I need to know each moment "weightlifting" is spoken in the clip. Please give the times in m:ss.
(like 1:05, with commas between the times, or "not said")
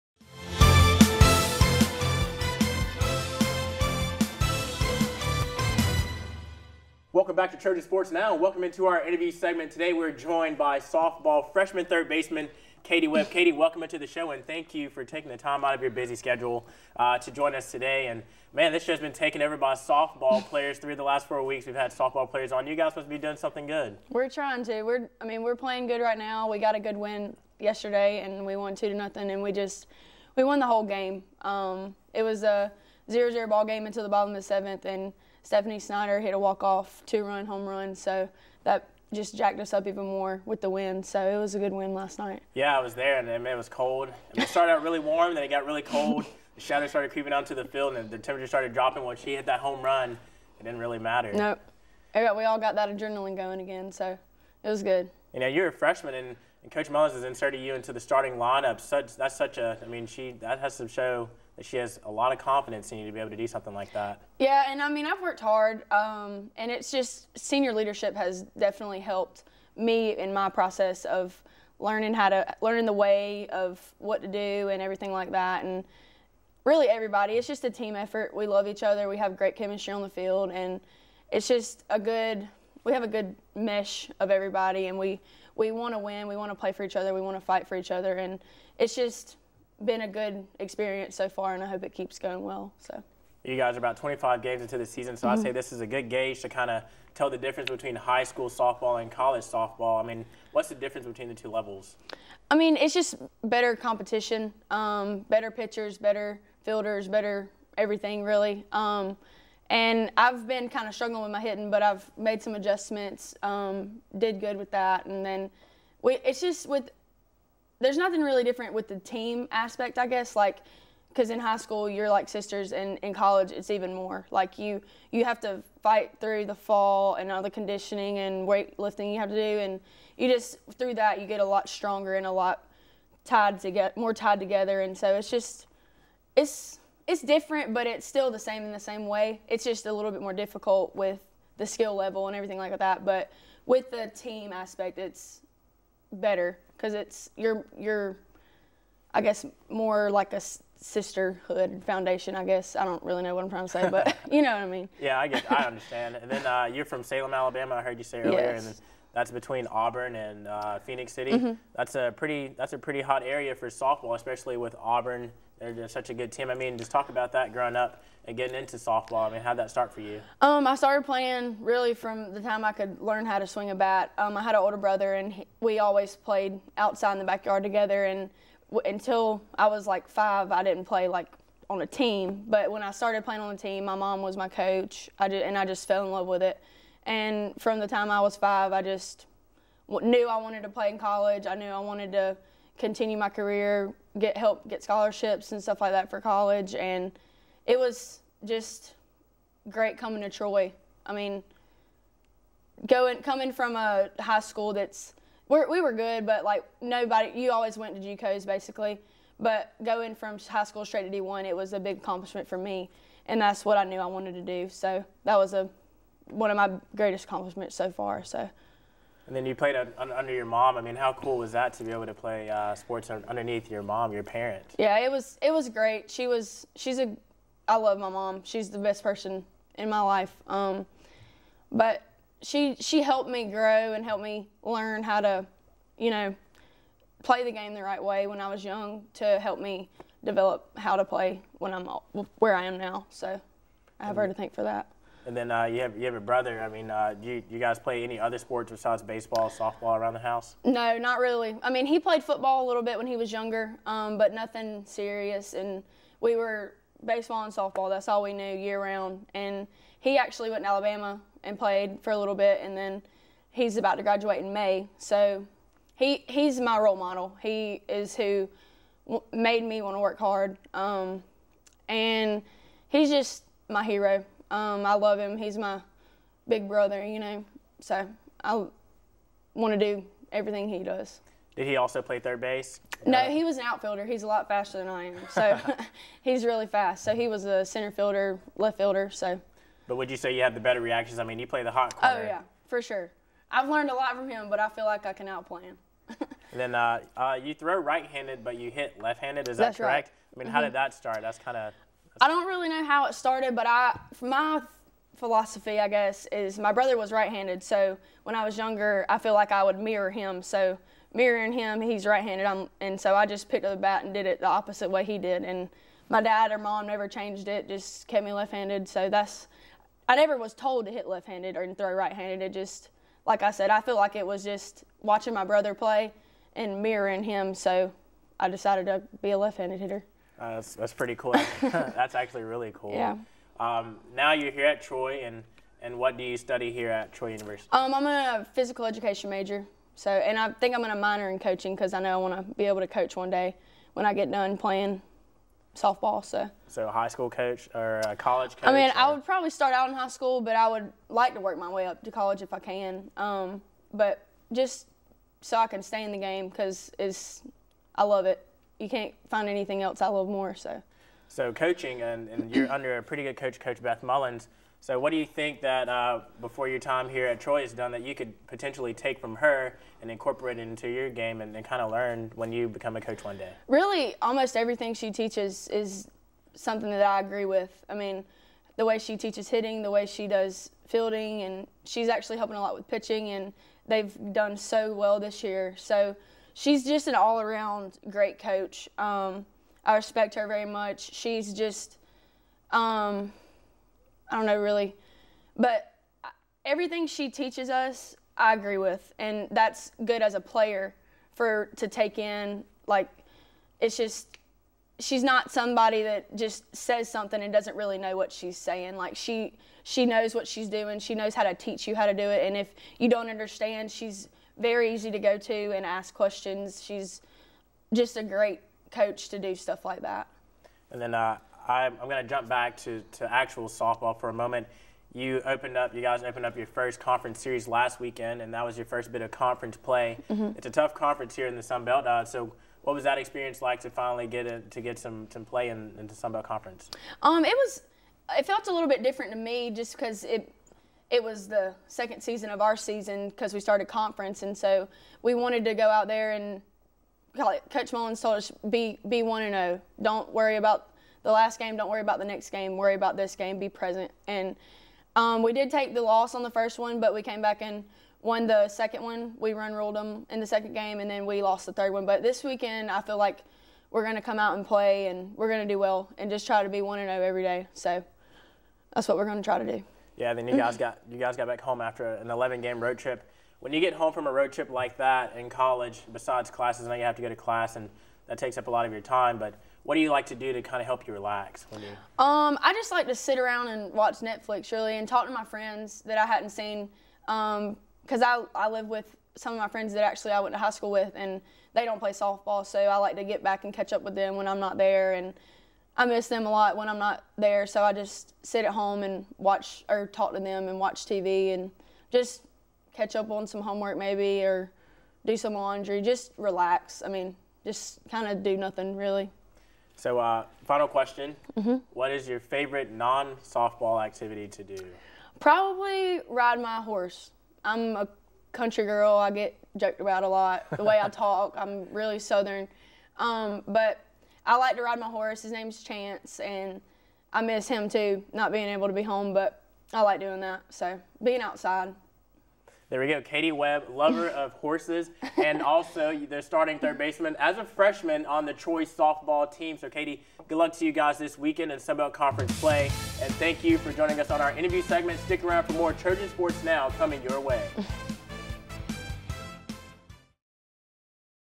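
2:08.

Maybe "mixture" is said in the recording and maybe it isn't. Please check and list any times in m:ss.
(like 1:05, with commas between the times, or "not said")
not said.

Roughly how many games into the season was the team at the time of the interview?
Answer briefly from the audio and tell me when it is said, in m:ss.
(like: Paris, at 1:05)
25, at 1:33.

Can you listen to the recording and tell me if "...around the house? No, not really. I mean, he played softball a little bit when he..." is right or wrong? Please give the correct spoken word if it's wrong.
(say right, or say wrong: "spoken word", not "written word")
wrong: "football", not "softball".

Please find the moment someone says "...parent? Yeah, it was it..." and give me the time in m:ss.
3:44.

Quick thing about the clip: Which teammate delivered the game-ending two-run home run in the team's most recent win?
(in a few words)
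Stephanie Snyder.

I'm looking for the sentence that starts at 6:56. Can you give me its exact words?
She's just a great coach to do stuff like that.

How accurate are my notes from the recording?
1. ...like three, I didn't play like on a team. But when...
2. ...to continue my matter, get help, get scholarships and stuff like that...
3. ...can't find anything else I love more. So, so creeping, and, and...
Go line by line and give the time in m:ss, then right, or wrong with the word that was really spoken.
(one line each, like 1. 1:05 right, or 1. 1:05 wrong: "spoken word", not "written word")
1. 2:59 wrong: "five", not "three"
2. 3:12 wrong: "career", not "matter"
3. 5:58 wrong: "coaching", not "creeping".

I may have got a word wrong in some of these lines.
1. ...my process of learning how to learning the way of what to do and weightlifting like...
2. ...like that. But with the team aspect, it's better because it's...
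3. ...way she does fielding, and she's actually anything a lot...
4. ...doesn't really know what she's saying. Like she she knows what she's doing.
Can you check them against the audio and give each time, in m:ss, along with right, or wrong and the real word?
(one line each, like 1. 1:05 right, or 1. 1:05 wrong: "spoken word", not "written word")
1. 1:10 wrong: "everything", not "weightlifting"
2. 2:22 right
3. 6:19 wrong: "helping", not "anything"
4. 6:47 right.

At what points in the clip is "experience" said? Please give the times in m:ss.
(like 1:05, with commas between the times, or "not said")
1:30, 7:13.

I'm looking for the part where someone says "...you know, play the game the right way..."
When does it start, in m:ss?
3:55.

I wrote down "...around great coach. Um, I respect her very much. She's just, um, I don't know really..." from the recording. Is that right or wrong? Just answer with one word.
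right.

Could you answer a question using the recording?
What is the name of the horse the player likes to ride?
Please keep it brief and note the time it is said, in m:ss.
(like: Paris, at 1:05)
Chance, at 8:45.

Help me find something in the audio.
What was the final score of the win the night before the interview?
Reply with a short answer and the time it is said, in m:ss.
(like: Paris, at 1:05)
2-0, at 0:28.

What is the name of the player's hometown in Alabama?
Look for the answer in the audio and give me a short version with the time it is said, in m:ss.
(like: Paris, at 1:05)
Salem, at 2:37.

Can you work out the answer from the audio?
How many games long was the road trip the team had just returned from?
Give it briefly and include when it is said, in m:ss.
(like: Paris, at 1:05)
11, at 7:52.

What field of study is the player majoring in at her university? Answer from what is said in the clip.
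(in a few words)
Physical education.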